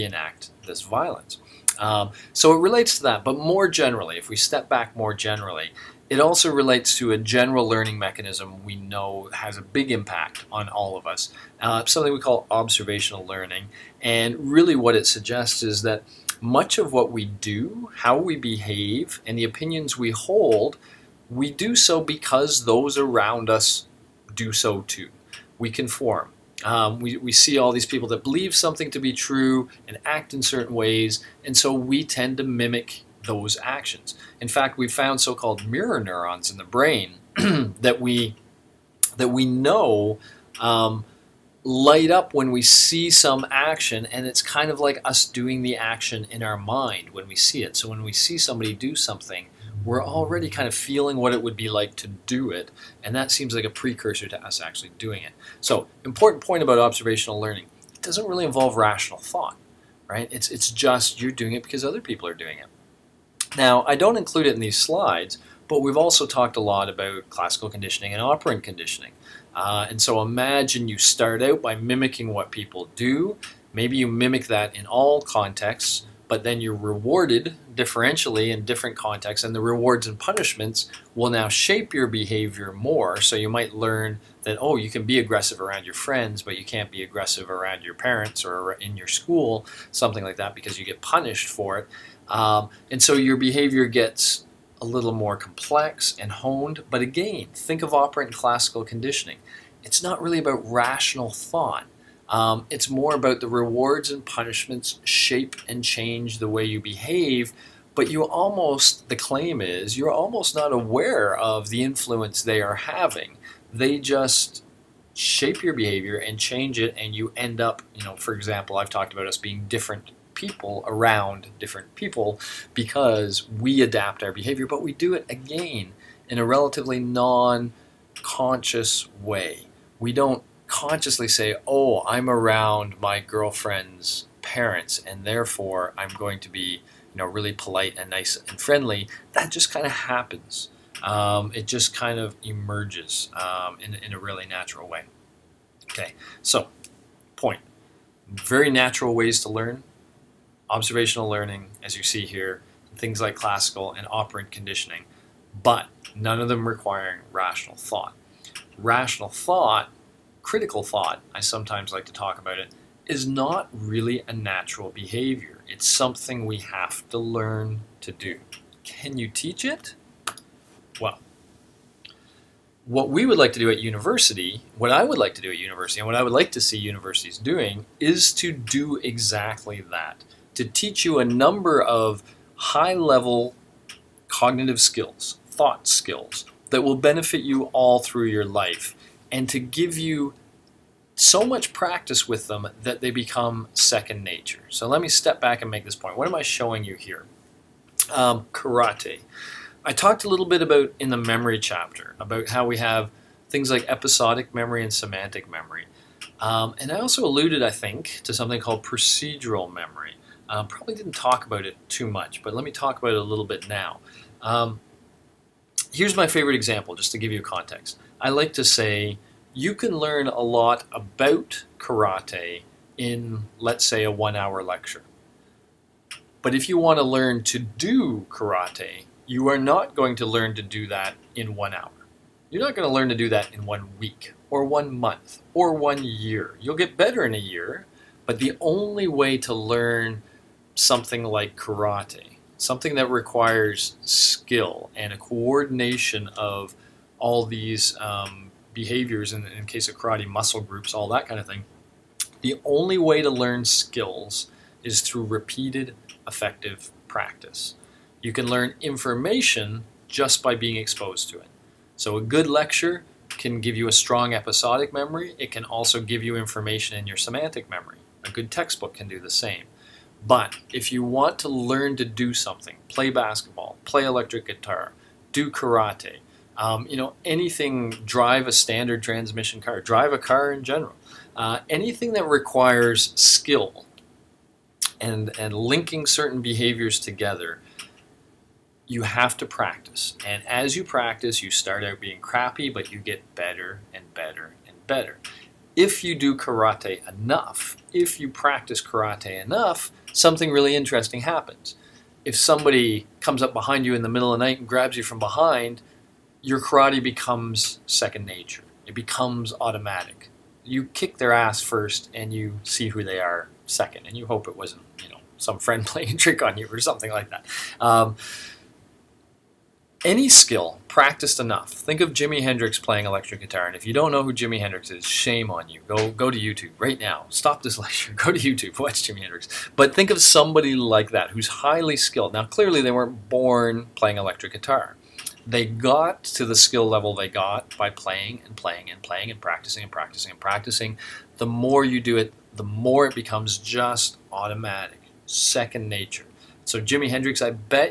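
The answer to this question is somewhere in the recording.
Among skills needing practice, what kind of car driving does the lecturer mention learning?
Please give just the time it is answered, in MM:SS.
04:38.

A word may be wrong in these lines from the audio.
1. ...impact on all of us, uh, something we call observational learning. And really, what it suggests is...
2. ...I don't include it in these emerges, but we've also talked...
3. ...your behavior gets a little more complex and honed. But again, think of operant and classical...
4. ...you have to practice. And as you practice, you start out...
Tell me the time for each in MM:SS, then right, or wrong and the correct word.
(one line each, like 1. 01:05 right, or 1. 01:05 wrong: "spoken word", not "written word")
1. 00:09 right
2. 01:03 wrong: "slides", not "emerges"
3. 01:33 right
4. 04:48 right.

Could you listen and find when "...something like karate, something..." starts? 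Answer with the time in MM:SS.
04:00.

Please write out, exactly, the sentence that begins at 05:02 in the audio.
If somebody comes up behind you in the middle of the night and grabs you from behind, your karate becomes second nature.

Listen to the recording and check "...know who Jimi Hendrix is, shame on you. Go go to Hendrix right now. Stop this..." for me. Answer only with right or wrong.
wrong.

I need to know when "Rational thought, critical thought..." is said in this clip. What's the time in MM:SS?
02:38.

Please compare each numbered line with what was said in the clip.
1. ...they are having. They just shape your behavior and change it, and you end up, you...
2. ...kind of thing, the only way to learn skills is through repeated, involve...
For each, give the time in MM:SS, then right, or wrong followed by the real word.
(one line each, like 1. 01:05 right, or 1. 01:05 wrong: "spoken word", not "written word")
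1. 01:52 right
2. 04:11 wrong: "effective", not "involve".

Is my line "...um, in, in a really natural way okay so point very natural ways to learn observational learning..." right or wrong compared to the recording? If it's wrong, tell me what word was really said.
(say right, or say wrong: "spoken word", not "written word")
right.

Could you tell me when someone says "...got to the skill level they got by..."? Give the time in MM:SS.
05:35.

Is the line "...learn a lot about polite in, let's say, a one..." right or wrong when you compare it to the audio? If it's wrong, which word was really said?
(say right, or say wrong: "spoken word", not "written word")
wrong: "karate", not "polite".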